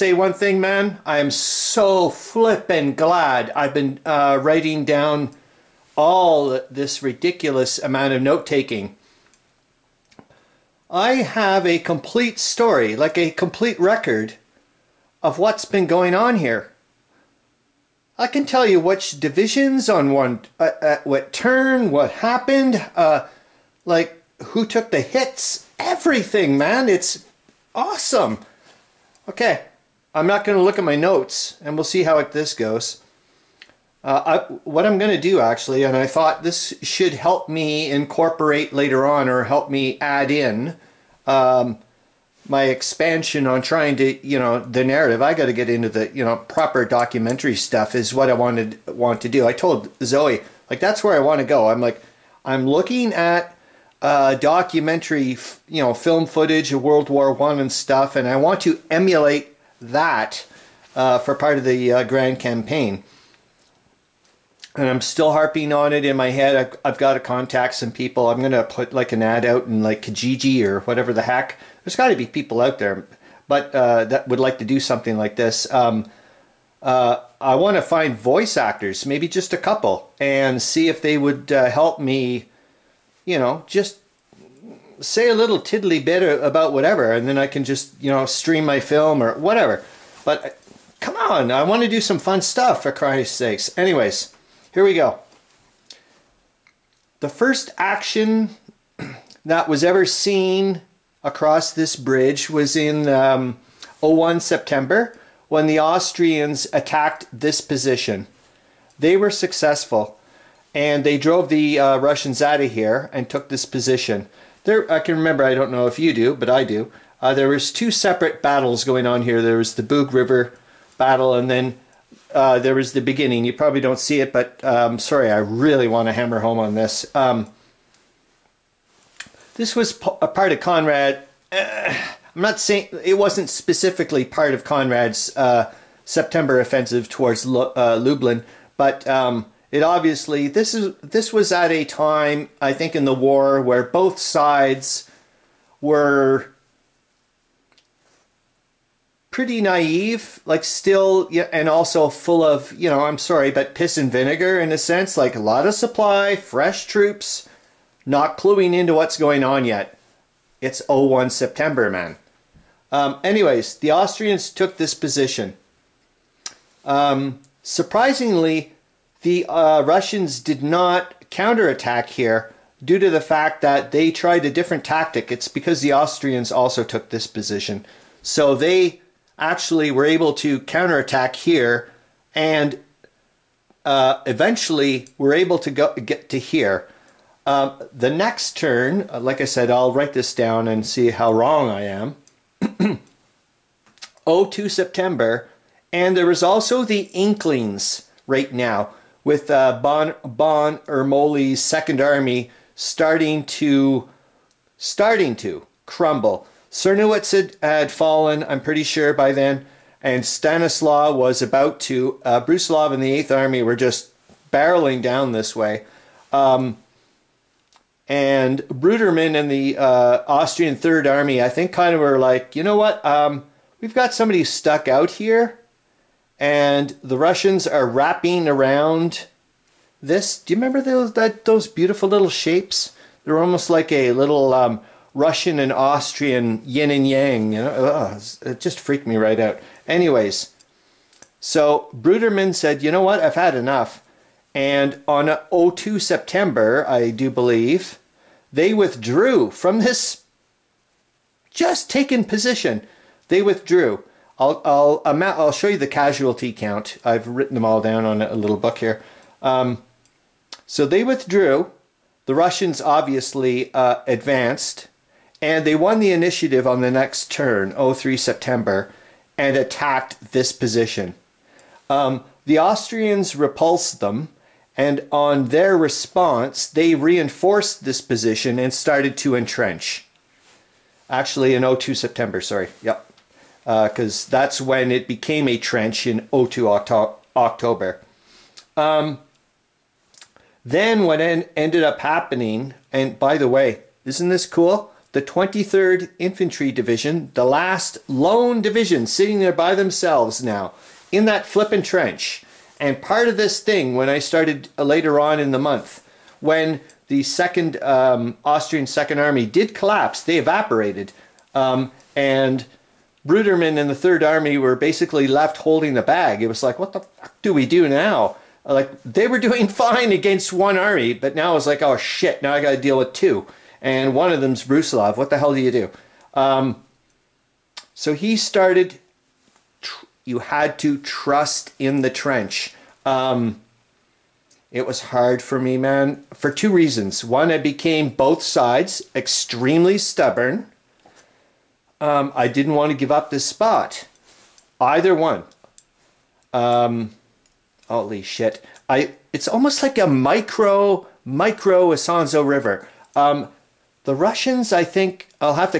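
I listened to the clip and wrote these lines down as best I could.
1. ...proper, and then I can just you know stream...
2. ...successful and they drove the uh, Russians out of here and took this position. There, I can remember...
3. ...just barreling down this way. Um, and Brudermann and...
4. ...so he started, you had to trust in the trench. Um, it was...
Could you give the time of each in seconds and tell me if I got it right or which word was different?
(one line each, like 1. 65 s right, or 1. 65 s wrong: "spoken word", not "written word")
1. 86 s wrong: "whatever", not "proper"
2. 109 s right
3. 213 s right
4. 327 s right.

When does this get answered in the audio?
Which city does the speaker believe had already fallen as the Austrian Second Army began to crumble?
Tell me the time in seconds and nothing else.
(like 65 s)
206 s.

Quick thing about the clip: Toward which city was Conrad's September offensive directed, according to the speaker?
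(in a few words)
Lublin.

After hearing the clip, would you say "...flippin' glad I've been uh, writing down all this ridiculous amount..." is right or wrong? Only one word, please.
right.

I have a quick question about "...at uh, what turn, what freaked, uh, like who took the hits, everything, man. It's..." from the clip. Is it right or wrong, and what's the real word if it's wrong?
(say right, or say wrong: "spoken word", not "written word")
wrong: "happened", not "freaked".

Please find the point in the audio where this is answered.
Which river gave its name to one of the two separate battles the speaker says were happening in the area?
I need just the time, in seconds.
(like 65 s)
119 s.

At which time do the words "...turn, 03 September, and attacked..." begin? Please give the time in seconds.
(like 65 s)
267 s.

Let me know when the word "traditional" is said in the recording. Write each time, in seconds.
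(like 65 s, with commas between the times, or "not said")
not said.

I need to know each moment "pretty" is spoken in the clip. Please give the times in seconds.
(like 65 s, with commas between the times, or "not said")
149 s, 208 s.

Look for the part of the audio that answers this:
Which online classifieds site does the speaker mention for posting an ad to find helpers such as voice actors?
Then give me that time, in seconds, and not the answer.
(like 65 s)
70 s.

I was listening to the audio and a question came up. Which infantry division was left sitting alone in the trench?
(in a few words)
23rd Infantry Division.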